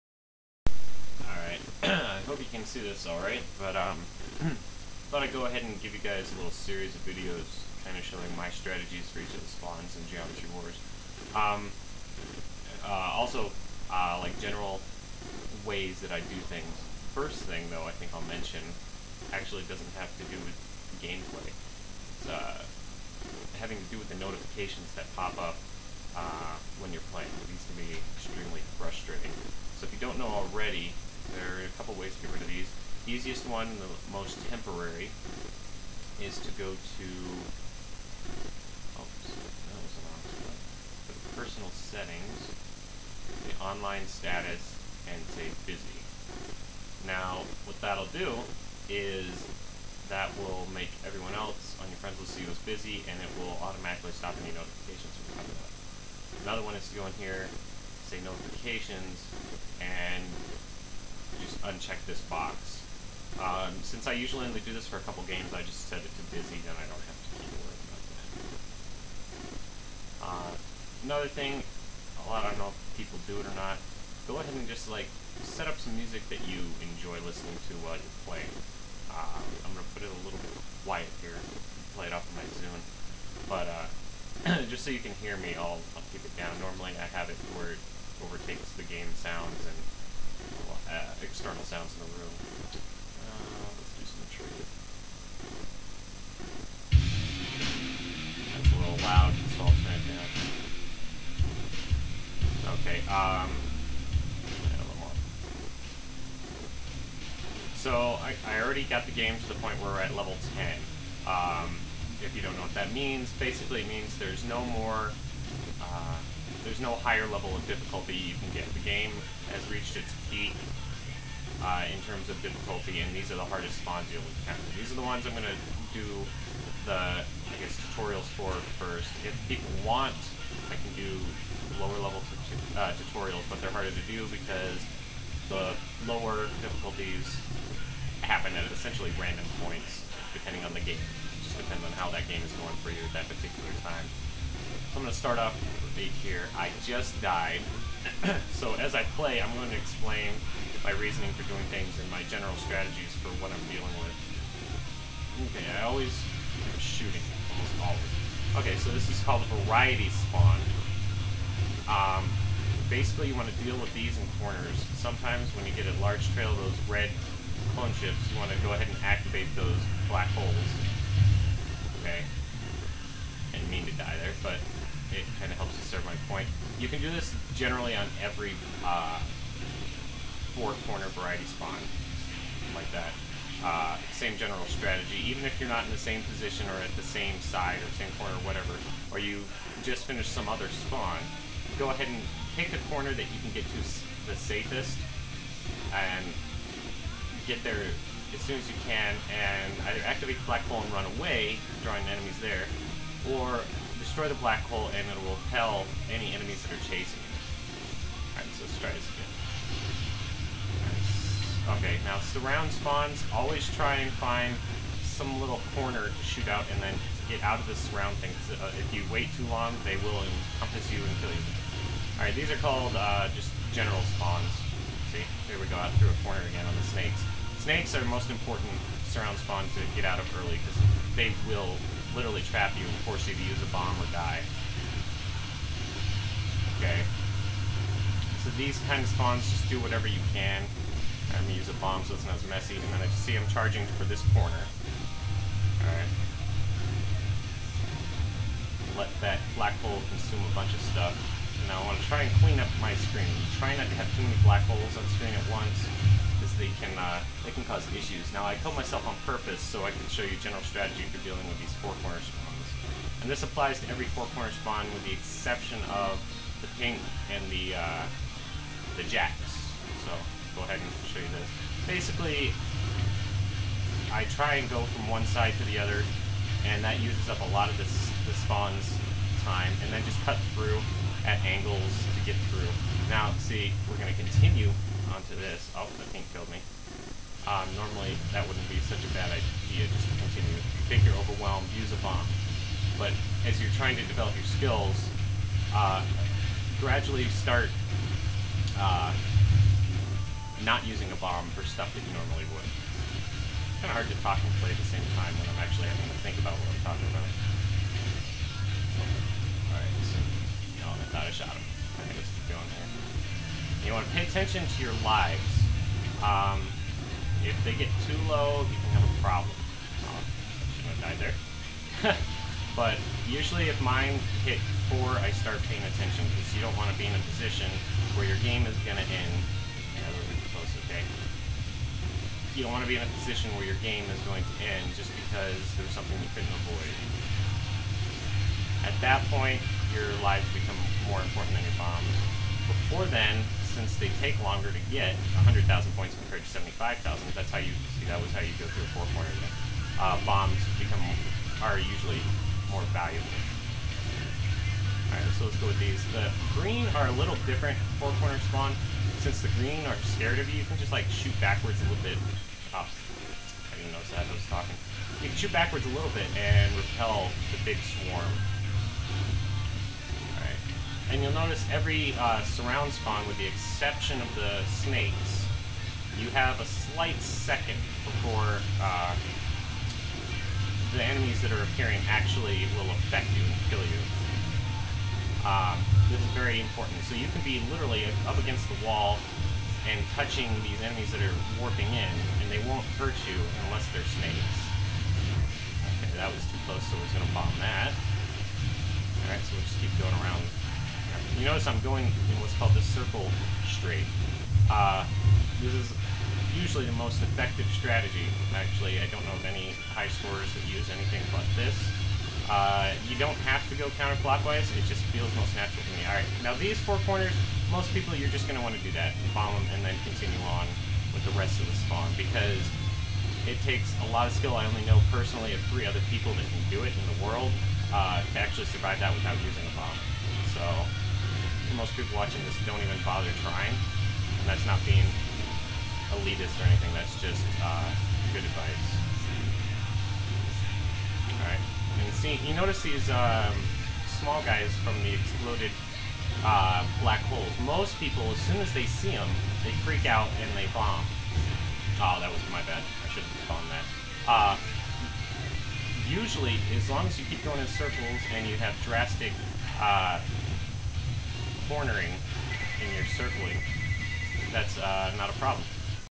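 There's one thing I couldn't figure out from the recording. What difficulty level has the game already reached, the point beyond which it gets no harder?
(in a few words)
10.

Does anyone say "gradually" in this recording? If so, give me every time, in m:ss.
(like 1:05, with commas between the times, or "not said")
4:56.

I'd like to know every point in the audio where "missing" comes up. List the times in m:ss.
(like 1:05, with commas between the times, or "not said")
not said.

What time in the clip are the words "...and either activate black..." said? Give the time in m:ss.
3:19.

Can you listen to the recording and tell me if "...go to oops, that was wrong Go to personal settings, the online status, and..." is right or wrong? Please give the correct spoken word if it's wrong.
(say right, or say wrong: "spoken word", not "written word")
right.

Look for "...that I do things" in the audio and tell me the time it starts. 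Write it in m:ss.
0:16.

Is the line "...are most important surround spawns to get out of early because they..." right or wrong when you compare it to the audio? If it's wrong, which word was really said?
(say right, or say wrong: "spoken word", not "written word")
right.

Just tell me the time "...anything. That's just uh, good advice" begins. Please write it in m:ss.
7:16.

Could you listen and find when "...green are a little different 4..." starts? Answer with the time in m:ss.
5:56.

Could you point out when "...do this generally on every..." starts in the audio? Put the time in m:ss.
2:56.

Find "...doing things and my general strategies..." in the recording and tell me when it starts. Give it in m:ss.
2:31.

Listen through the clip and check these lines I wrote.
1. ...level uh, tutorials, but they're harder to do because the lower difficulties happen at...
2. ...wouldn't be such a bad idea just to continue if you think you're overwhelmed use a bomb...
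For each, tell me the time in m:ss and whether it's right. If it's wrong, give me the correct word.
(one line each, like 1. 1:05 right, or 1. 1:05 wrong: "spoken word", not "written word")
1. 2:11 right
2. 4:48 right.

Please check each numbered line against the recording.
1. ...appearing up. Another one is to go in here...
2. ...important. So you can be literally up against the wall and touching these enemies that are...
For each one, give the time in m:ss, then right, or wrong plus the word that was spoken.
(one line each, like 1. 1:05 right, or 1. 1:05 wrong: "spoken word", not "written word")
1. 0:55 wrong: "coming", not "appearing"
2. 6:26 right.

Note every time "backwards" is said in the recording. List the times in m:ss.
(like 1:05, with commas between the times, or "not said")
6:01, 6:05.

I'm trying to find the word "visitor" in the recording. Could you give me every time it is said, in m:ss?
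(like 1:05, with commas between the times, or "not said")
not said.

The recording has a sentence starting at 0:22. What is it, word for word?
It's uh, having to do with the notifications that pop up uh, when you're playing.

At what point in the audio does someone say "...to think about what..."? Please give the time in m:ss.
5:06.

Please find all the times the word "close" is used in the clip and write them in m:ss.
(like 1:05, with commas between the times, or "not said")
5:30, 6:36.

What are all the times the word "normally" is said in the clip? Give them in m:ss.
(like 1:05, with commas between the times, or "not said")
1:26, 4:47, 5:02.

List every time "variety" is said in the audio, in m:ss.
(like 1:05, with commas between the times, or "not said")
2:39, 3:01.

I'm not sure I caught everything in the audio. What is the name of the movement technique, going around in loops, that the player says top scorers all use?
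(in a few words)
circle strafe.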